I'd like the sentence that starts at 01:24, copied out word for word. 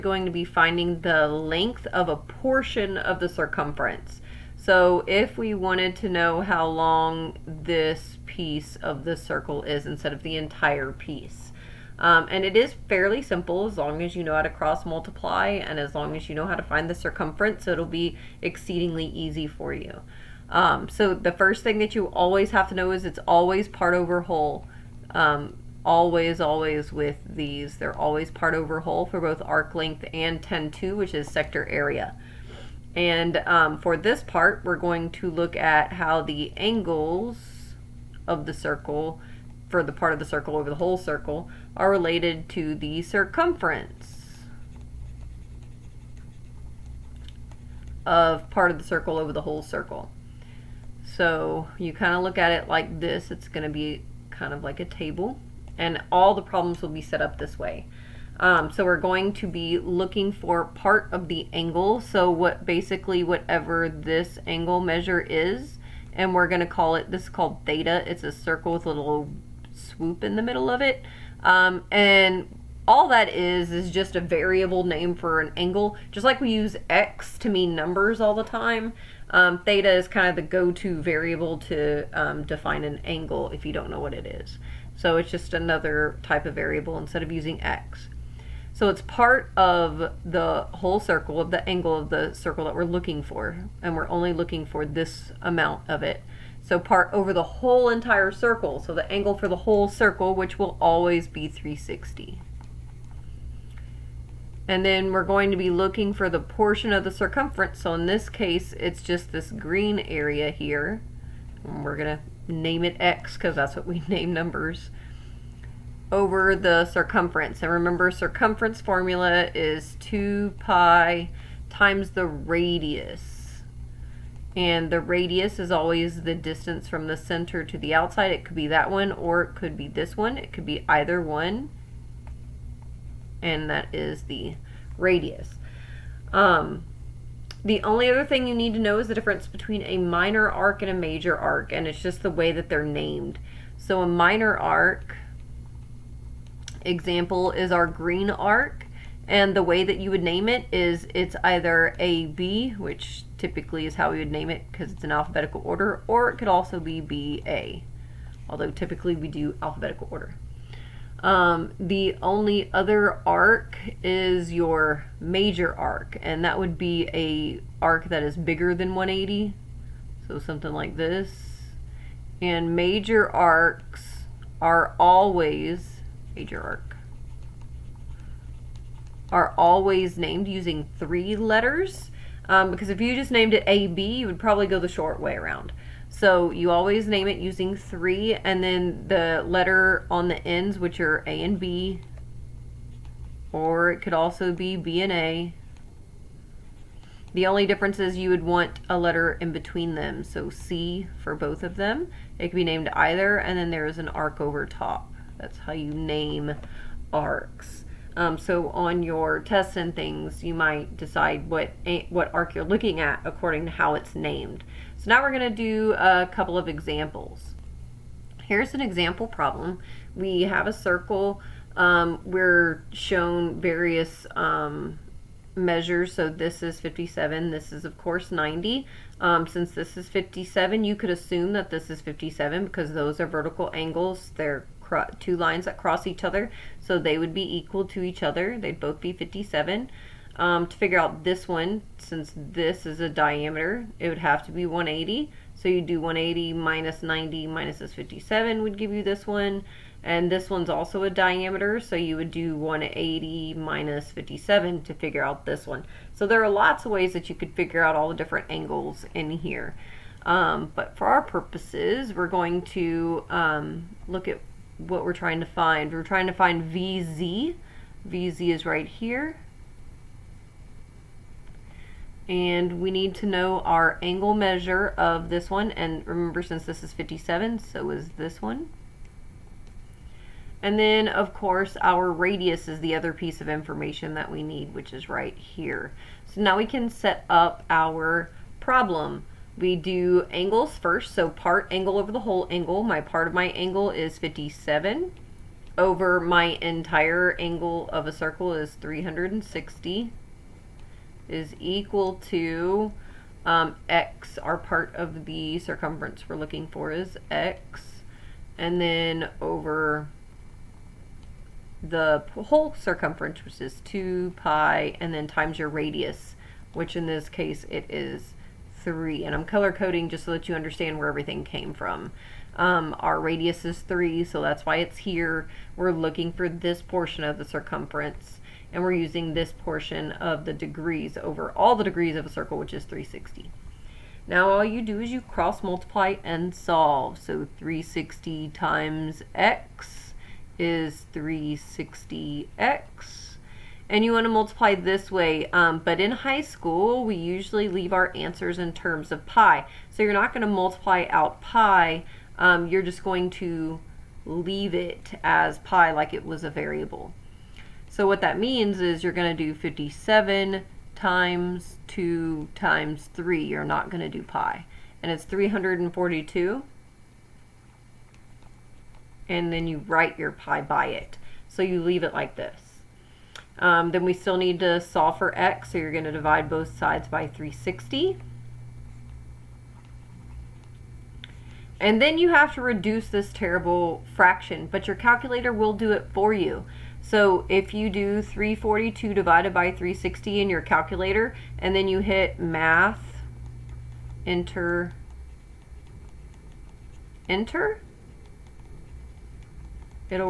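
So it's just another type of variable instead of using x.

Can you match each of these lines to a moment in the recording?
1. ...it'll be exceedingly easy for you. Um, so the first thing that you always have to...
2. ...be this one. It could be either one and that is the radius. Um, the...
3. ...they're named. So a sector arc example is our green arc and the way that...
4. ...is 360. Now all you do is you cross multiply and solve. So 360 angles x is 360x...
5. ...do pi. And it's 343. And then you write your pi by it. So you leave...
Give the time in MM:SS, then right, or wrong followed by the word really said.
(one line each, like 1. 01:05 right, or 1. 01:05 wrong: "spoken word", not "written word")
1. 00:17 right
2. 02:09 right
3. 02:22 wrong: "minor", not "sector"
4. 05:32 wrong: "times", not "angles"
5. 06:04 wrong: "342", not "343".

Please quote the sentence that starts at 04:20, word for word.
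Um, but for our purposes, we're going to um, look at what we're trying to find.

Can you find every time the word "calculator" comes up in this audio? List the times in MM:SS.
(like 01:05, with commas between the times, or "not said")
06:24, 06:30.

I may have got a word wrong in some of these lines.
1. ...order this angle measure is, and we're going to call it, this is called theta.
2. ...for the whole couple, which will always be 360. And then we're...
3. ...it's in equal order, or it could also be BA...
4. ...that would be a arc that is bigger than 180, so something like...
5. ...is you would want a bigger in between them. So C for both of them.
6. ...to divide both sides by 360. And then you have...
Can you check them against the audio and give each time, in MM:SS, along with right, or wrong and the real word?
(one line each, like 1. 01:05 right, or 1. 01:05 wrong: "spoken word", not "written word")
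1. 01:03 wrong: "whatever", not "order"
2. 01:39 wrong: "circle", not "couple"
3. 02:34 wrong: "alphabetical", not "equal"
4. 02:46 right
5. 03:17 wrong: "letter", not "bigger"
6. 06:16 right.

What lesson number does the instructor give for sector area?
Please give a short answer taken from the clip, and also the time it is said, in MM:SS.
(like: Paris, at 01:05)
10-2, at 00:30.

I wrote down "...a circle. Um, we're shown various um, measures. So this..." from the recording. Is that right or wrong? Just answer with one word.
right.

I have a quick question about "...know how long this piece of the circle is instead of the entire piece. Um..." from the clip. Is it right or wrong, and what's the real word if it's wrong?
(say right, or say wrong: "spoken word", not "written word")
right.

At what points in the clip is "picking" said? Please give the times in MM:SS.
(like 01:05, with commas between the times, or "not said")
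not said.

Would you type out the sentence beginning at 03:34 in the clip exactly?
So now we're gonna do a couple of examples.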